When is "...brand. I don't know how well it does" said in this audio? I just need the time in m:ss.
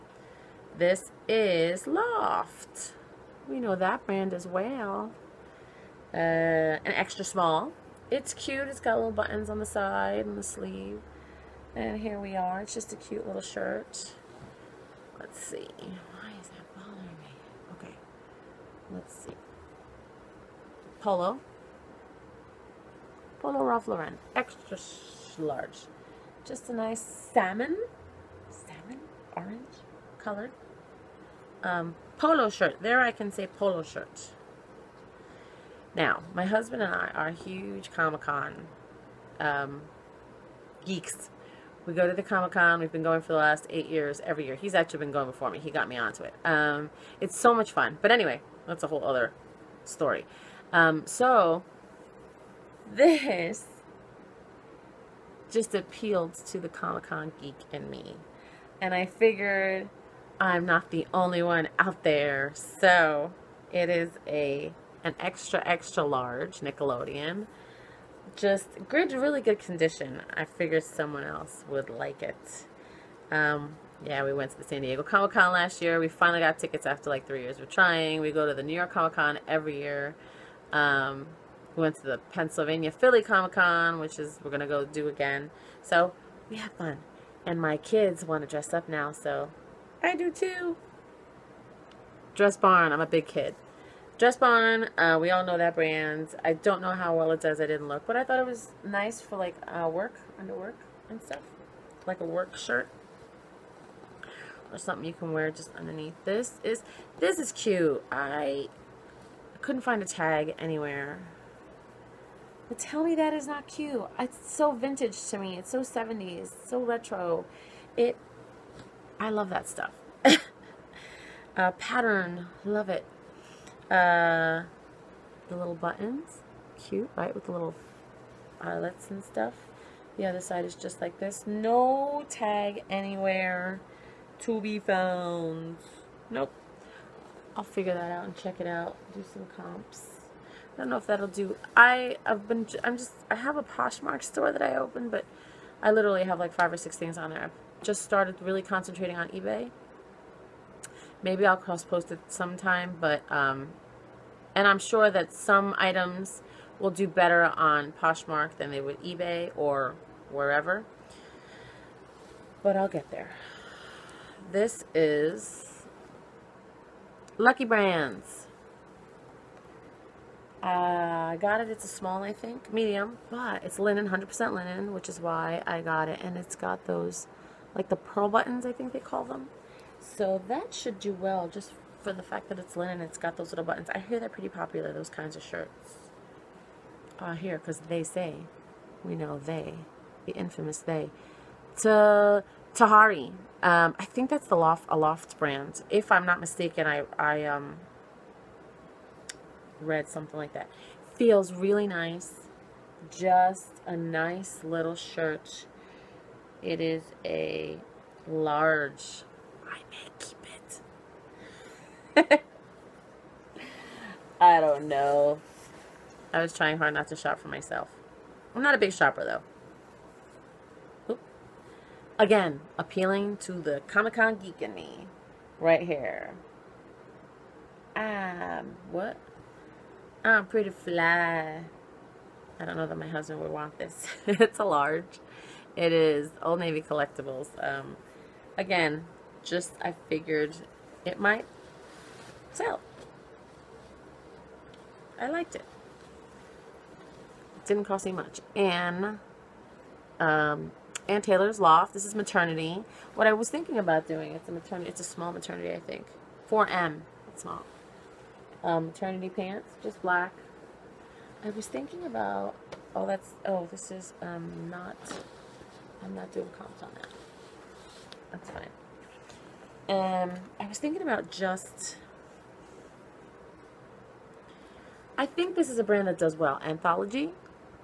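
1:35.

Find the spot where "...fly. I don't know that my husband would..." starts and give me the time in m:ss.
3:50.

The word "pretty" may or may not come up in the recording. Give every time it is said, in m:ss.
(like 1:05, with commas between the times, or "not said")
3:04, 3:50.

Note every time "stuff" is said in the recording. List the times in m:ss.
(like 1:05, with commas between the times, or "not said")
1:41, 1:59, 2:09.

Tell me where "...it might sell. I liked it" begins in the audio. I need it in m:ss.
4:01.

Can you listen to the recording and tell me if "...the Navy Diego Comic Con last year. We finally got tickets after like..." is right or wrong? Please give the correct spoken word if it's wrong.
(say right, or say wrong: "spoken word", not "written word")
wrong: "San", not "Navy".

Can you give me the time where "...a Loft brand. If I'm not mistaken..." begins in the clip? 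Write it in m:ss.
3:14.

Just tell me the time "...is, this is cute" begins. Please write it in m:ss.
1:46.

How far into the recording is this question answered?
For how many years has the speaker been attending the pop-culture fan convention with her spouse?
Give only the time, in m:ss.
0:43.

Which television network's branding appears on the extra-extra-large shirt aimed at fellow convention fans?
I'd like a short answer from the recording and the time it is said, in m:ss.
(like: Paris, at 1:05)
Nickelodeon, at 1:06.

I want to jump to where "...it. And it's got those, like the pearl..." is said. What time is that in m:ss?
2:56.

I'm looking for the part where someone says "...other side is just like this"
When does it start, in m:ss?
2:10.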